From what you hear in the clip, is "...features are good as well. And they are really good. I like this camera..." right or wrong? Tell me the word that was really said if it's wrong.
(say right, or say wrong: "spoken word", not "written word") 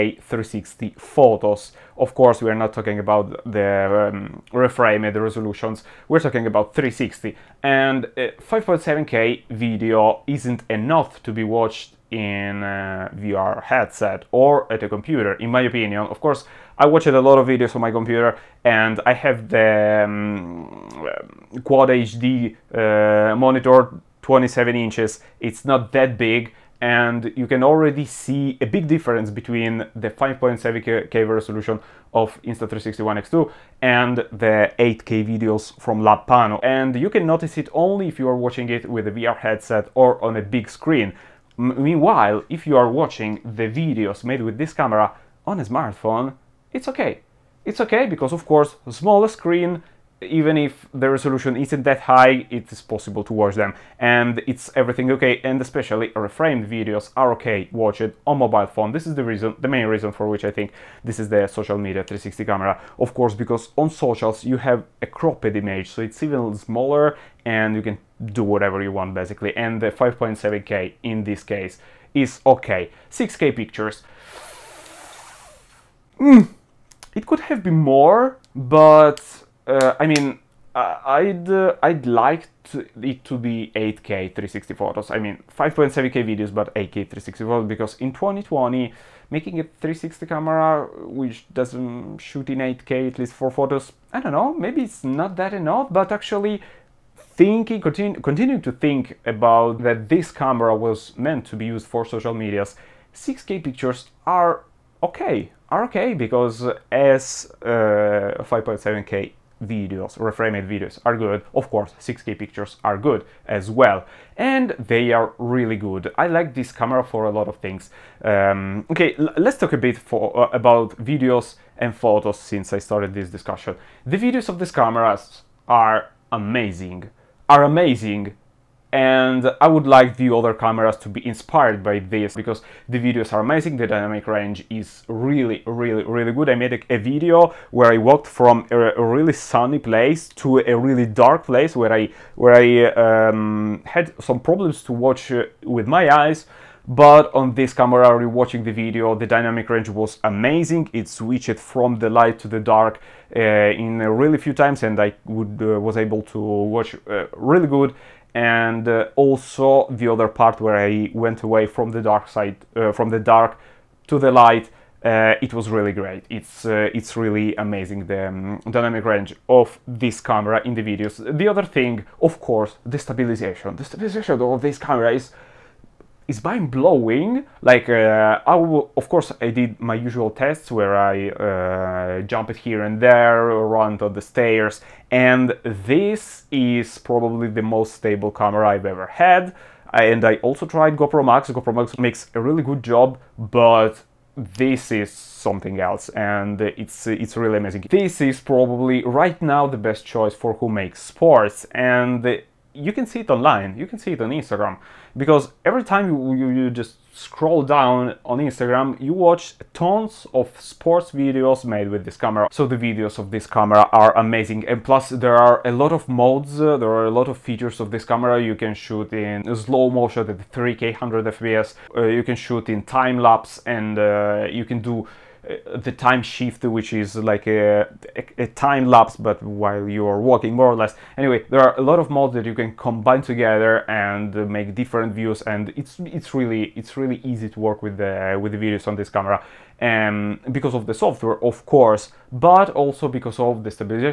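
wrong: "pictures", not "features".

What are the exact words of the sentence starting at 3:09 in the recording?
And I also tried GoPro Max.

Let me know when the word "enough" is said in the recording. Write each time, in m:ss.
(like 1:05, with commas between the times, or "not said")
0:10, 1:35.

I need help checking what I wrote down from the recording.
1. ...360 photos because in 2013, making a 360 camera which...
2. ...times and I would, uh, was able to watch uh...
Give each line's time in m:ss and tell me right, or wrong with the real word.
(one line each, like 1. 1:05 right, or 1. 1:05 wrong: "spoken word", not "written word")
1. 1:26 wrong: "2020", not "2013"
2. 2:34 right.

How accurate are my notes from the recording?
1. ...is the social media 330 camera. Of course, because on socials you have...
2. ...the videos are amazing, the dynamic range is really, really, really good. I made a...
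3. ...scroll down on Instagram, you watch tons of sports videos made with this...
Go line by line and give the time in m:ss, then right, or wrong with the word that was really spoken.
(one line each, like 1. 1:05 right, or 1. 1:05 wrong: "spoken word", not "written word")
1. 1:01 wrong: "360", not "330"
2. 2:12 right
3. 3:27 right.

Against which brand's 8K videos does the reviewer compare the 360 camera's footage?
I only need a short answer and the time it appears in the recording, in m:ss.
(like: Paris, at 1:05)
Labpano, at 0:36.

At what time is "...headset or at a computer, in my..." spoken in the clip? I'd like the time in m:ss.
0:13.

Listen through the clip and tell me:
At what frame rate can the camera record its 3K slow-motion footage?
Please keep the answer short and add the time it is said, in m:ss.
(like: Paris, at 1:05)
100 FPS, at 3:40.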